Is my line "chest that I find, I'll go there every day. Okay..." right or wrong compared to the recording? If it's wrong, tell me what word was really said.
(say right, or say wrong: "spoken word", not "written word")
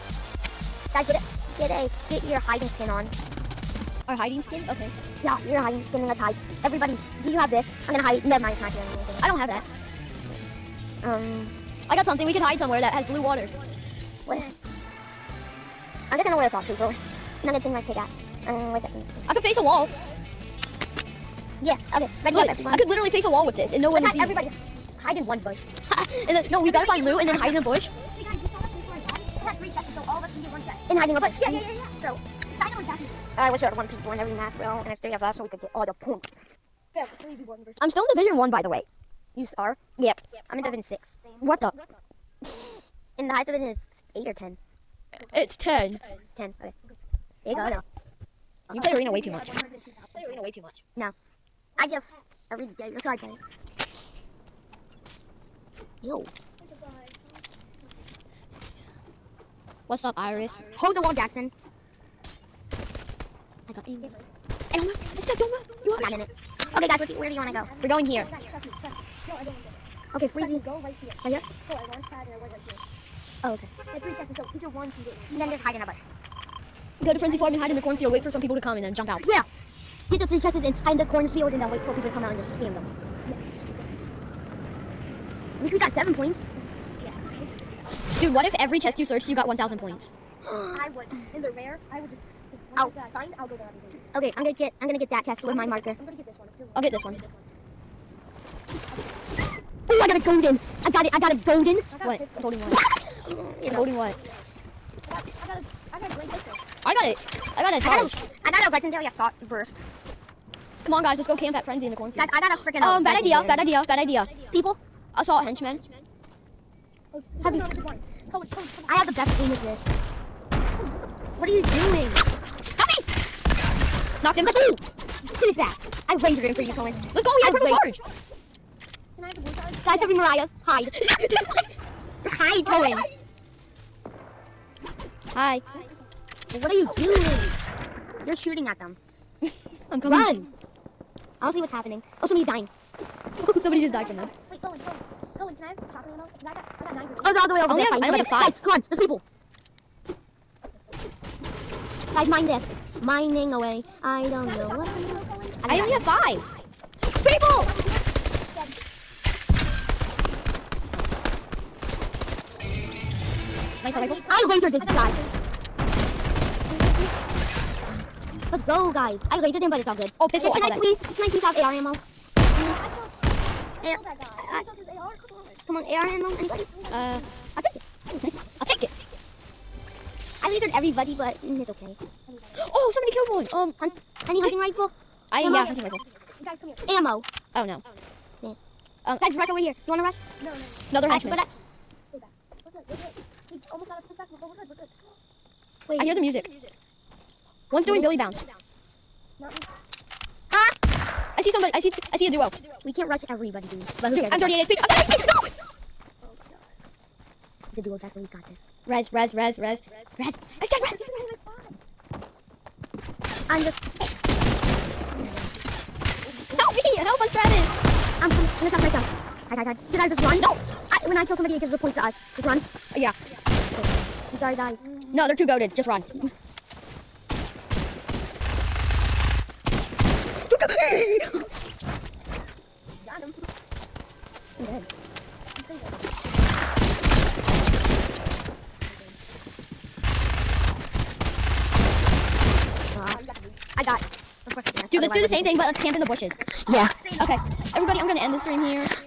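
right.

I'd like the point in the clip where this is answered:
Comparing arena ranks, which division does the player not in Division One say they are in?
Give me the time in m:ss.
0:40.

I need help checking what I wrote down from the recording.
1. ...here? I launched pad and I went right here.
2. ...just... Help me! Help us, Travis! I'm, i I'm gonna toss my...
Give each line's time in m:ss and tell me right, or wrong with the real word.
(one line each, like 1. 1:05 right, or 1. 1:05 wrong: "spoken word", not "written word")
1. 1:11 right
2. 3:33 right.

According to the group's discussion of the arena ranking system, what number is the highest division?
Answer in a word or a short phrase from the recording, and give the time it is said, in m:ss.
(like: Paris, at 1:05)
10, at 0:45.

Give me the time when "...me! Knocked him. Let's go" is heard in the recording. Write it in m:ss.
2:02.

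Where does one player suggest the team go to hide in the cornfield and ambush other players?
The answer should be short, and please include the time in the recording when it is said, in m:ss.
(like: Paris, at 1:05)
Frenzy Farm, at 1:17.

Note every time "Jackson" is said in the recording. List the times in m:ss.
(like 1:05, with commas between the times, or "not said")
1:01, 3:27.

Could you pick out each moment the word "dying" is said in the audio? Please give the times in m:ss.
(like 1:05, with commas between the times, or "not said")
2:22.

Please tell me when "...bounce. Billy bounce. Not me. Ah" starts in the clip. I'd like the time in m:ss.
3:18.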